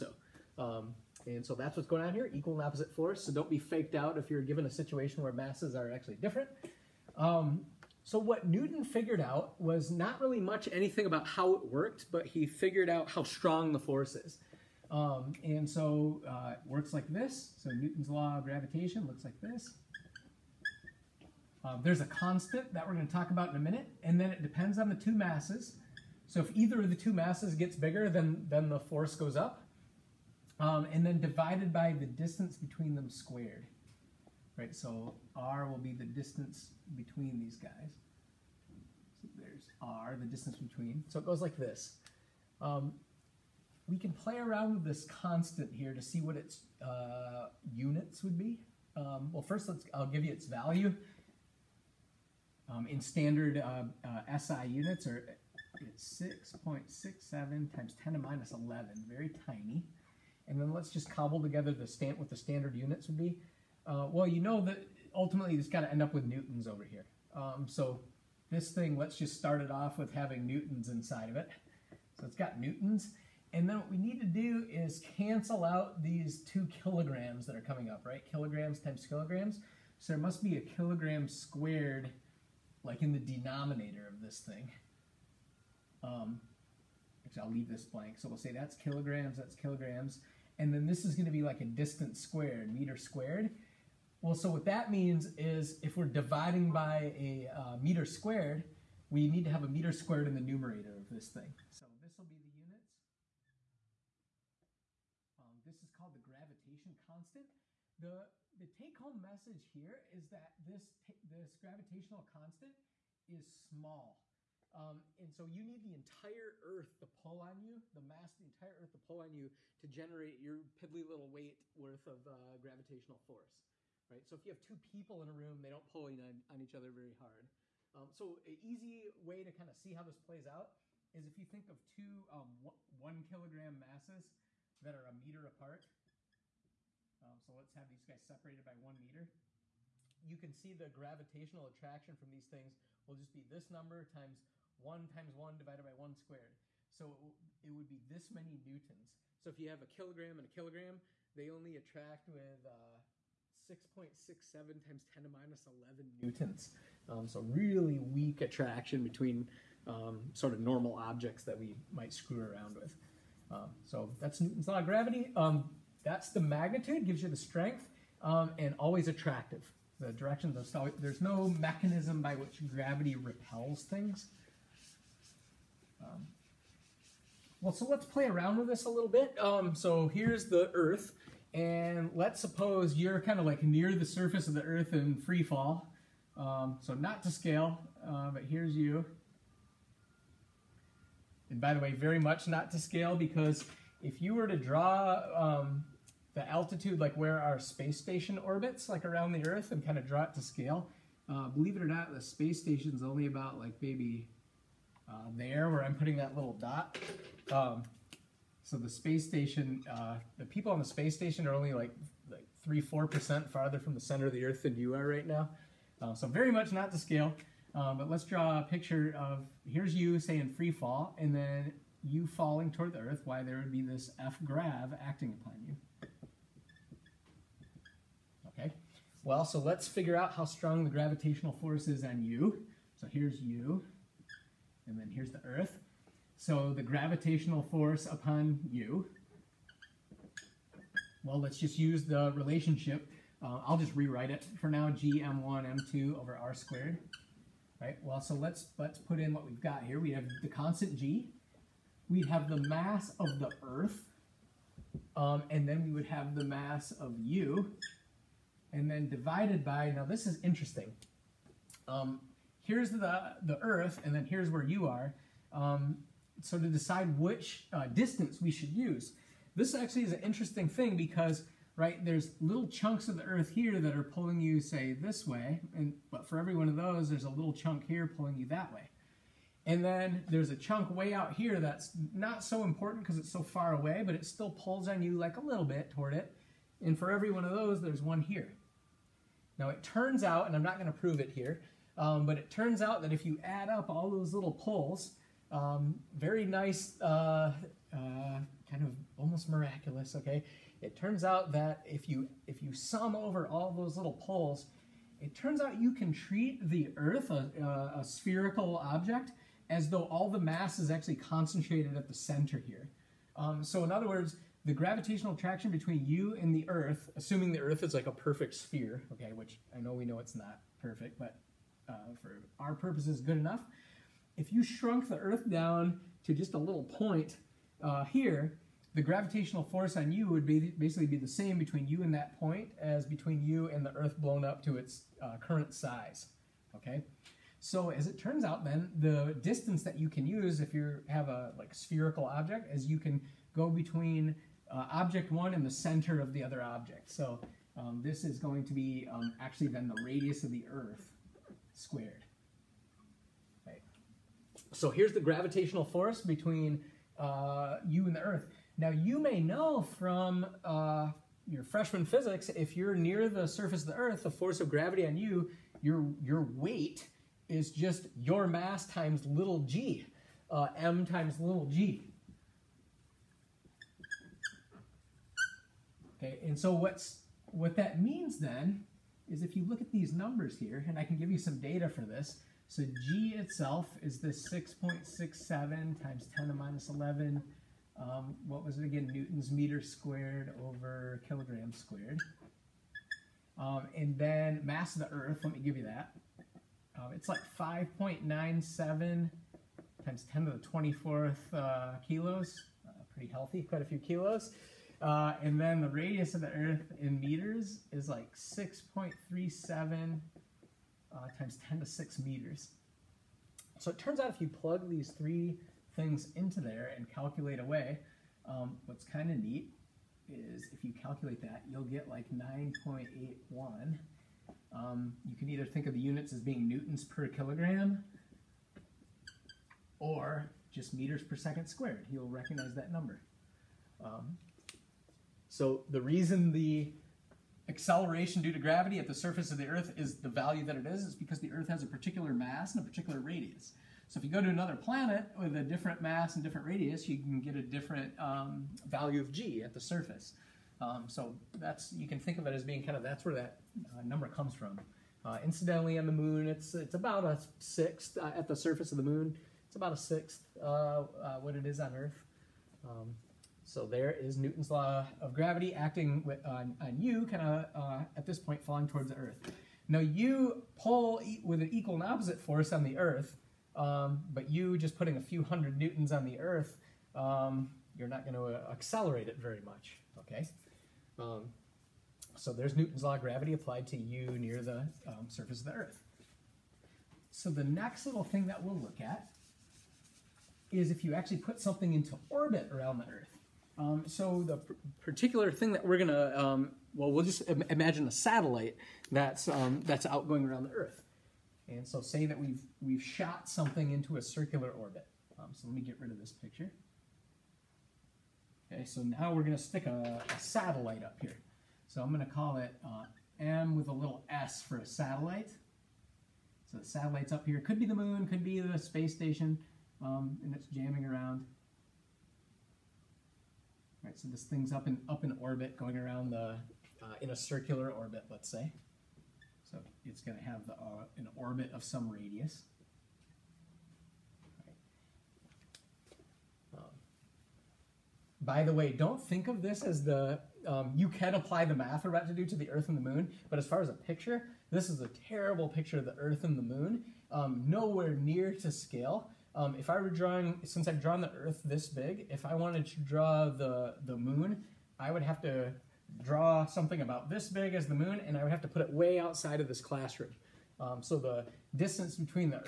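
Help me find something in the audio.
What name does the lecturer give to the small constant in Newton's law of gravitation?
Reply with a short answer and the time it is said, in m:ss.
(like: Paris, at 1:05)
Gravitation constant, at 1:46.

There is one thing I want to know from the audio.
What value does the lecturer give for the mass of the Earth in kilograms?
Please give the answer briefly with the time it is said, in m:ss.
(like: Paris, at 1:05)
5.97 x 10^24, at 6:37.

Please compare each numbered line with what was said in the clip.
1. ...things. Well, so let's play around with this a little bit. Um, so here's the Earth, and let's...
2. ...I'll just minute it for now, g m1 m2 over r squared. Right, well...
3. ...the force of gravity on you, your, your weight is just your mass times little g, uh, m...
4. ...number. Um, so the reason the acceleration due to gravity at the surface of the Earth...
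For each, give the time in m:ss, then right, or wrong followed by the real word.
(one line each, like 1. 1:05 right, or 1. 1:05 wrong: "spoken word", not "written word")
1. 2:53 right
2. 4:03 wrong: "rewrite", not "minute"
3. 6:04 right
4. 7:12 right.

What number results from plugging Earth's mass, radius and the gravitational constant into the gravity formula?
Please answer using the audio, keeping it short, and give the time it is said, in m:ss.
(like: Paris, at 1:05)
9.81, at 7:02.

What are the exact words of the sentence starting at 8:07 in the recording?
So the next little thing that we'll look at is if you actually put something into orbit around the Earth.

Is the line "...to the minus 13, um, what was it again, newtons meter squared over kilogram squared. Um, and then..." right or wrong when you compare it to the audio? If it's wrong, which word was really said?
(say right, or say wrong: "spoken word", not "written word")
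wrong: "11", not "13".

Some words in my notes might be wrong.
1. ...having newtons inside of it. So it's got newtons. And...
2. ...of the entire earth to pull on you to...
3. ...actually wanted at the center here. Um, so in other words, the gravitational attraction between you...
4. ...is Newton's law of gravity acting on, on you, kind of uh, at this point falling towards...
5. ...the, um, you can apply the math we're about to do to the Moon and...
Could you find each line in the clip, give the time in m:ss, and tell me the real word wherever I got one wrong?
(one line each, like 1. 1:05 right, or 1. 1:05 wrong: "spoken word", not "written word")
1. 1:10 right
2. 1:58 right
3. 5:10 wrong: "concentrated", not "wanted"
4. 7:44 right
5. 9:00 wrong: "Earth", not "Moon".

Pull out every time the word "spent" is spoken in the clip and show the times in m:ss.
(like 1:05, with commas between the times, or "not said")
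not said.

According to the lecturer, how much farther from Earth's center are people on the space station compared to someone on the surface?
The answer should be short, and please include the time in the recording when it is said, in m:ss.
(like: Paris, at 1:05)
3-4 percent, at 3:32.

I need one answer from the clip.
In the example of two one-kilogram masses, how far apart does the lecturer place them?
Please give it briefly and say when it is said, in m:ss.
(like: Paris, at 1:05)
One meter, at 2:18.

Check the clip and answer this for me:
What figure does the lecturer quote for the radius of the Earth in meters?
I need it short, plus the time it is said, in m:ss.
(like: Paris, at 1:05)
6.37 x 10^6, at 6:48.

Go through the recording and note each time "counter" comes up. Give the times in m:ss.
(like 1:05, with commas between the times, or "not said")
not said.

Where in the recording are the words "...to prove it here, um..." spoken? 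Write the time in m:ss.
4:50.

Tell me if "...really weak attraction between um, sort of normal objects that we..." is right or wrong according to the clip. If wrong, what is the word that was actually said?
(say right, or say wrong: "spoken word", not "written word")
right.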